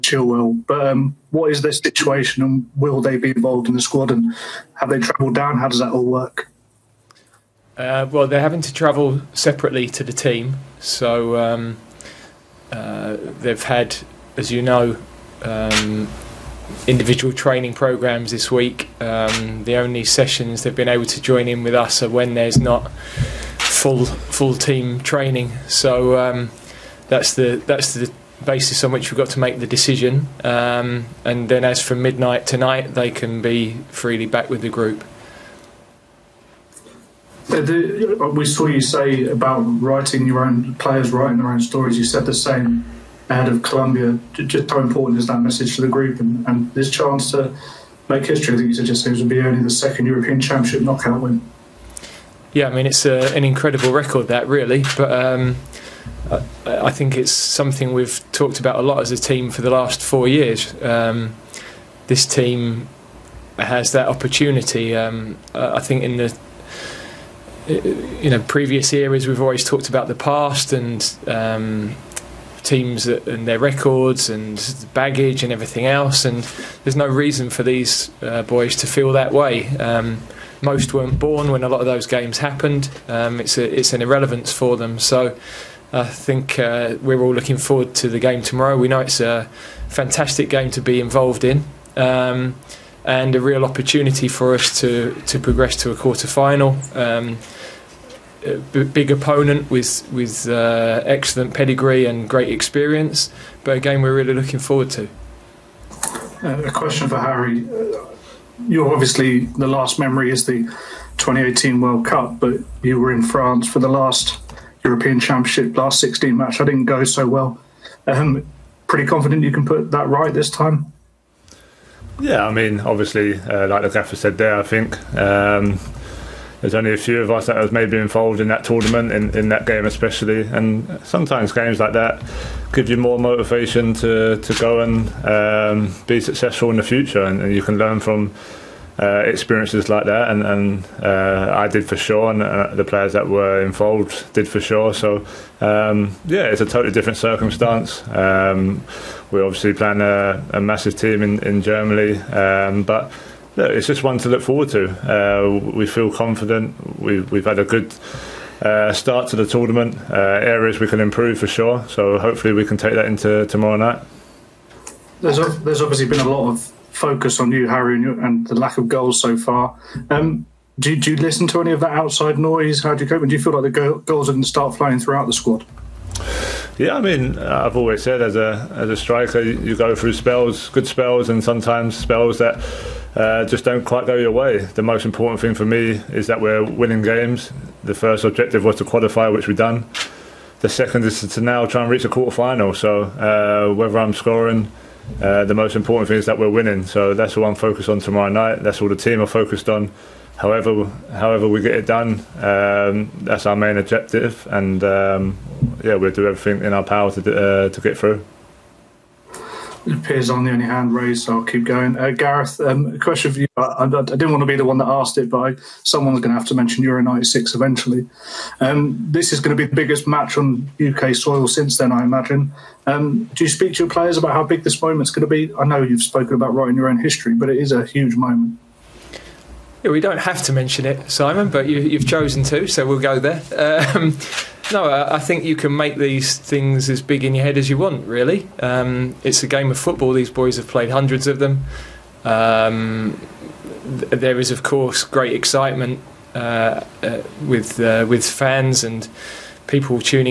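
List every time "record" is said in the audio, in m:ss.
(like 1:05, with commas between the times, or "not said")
0:53, 1:13.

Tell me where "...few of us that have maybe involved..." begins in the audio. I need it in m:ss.
2:06.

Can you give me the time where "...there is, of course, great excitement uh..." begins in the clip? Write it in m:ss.
4:03.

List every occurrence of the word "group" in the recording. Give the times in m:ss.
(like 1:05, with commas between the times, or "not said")
0:34, 0:45.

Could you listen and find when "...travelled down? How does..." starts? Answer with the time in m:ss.
0:04.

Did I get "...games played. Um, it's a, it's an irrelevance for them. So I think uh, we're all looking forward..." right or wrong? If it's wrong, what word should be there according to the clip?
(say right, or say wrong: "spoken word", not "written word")
wrong: "happened", not "played".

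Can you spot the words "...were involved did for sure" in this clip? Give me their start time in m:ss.
2:23.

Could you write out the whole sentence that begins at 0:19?
Um, the only sessions they've been able to join in with us are when there's not full full team training.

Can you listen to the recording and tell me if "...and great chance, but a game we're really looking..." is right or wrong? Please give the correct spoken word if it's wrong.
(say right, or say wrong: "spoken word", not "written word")
wrong: "experience", not "chance".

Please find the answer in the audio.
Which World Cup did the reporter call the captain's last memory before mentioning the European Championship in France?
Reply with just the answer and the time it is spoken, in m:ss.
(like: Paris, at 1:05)
2018 World Cup, at 1:51.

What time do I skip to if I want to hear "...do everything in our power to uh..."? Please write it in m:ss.
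3:26.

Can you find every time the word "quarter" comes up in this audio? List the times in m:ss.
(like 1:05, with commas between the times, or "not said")
1:35, 3:12.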